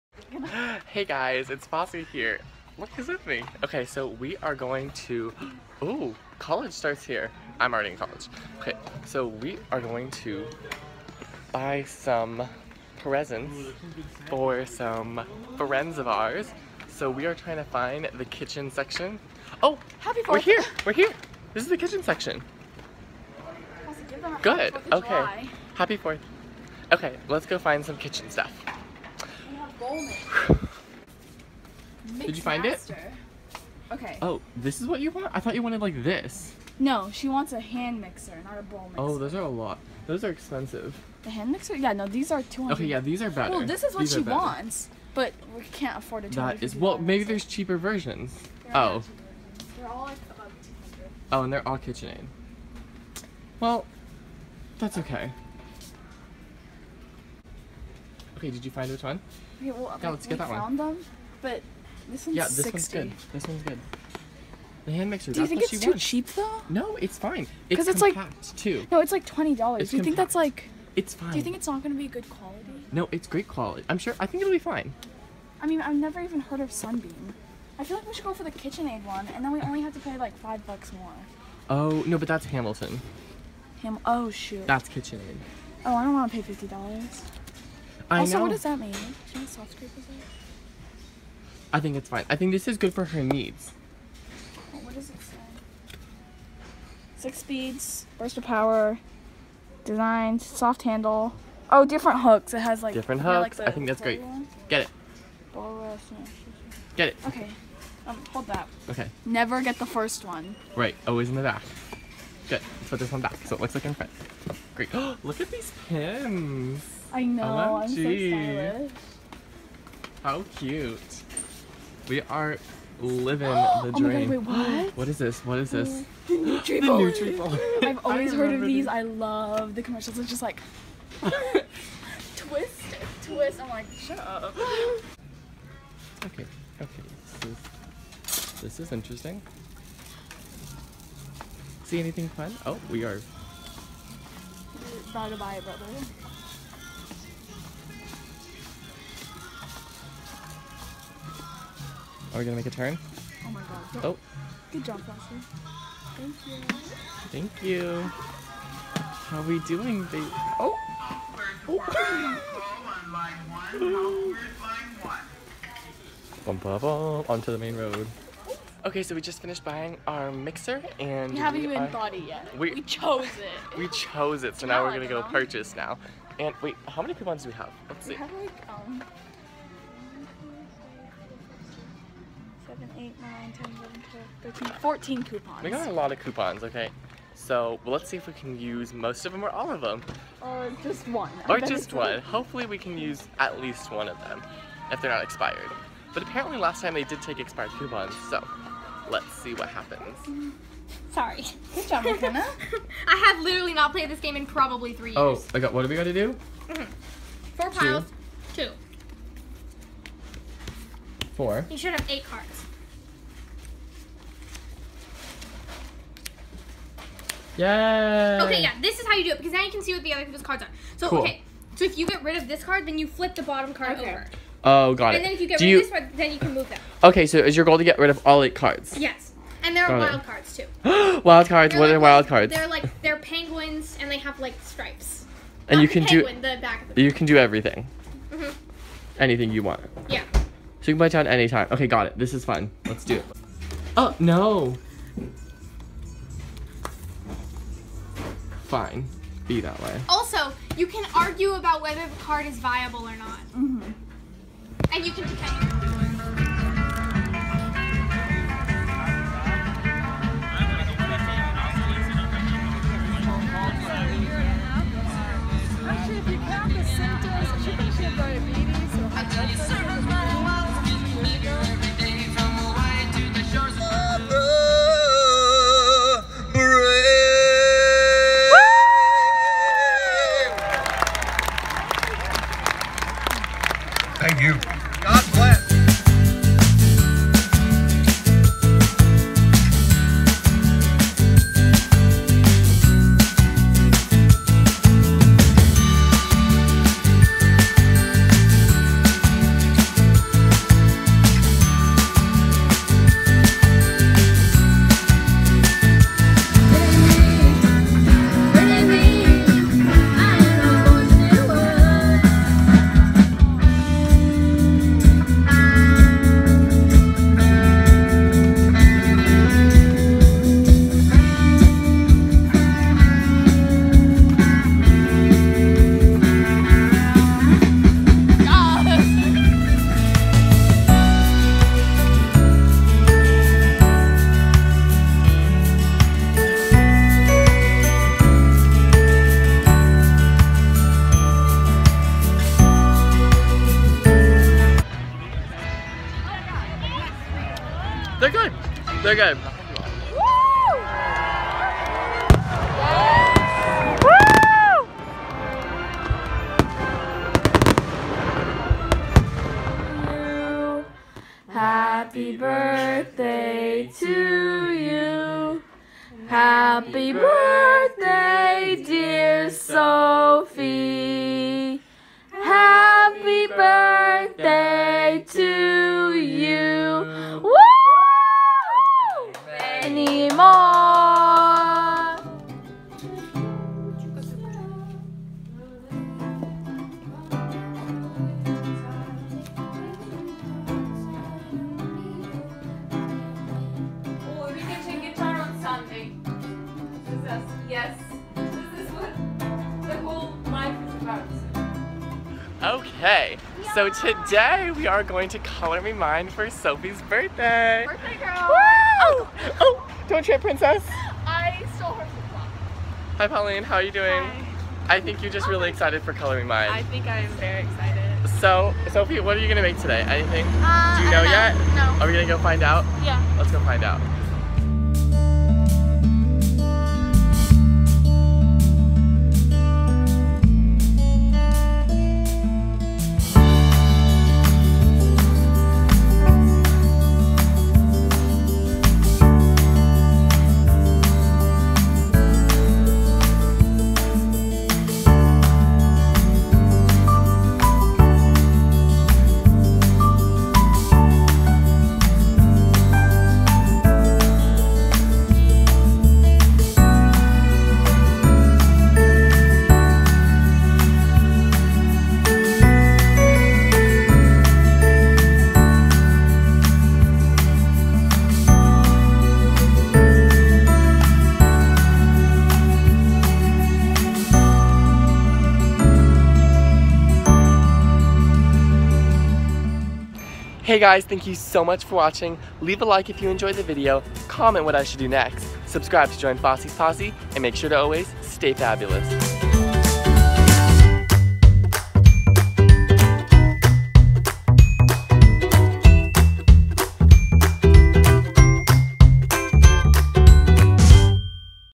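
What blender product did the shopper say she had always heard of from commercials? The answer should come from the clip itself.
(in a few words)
Nutribullet.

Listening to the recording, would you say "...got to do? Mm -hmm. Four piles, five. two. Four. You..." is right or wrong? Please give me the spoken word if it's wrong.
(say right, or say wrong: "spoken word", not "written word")
wrong: "two", not "five".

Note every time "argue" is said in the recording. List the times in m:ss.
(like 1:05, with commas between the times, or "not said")
4:11.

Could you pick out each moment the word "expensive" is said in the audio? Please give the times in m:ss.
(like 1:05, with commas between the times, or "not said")
0:40.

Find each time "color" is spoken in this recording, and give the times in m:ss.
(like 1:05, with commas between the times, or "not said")
6:45, 6:56.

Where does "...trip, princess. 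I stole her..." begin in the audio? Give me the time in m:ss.
6:50.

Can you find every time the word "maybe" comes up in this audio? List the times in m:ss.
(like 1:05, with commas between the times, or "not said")
0:46.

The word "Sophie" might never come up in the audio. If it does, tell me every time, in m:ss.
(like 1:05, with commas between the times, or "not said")
6:09, 6:46, 6:58.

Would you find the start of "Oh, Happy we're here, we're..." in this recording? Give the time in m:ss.
0:19.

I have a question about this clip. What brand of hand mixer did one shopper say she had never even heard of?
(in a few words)
Sunbeam.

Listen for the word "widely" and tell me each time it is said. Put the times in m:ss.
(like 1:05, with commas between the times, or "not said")
not said.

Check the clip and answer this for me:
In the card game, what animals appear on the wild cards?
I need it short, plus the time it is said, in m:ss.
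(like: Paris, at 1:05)
penguins, at 3:53.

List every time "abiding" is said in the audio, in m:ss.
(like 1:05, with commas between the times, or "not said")
not said.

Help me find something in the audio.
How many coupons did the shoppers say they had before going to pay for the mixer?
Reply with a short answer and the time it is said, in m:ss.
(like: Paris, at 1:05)
14, at 3:04.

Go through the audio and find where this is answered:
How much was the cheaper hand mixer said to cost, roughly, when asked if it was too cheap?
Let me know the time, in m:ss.
1:09.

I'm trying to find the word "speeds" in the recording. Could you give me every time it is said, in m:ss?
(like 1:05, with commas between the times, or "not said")
1:37.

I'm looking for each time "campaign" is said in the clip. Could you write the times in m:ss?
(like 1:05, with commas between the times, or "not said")
not said.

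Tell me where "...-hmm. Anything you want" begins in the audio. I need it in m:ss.
3:58.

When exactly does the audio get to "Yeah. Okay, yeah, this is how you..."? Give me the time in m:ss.
3:37.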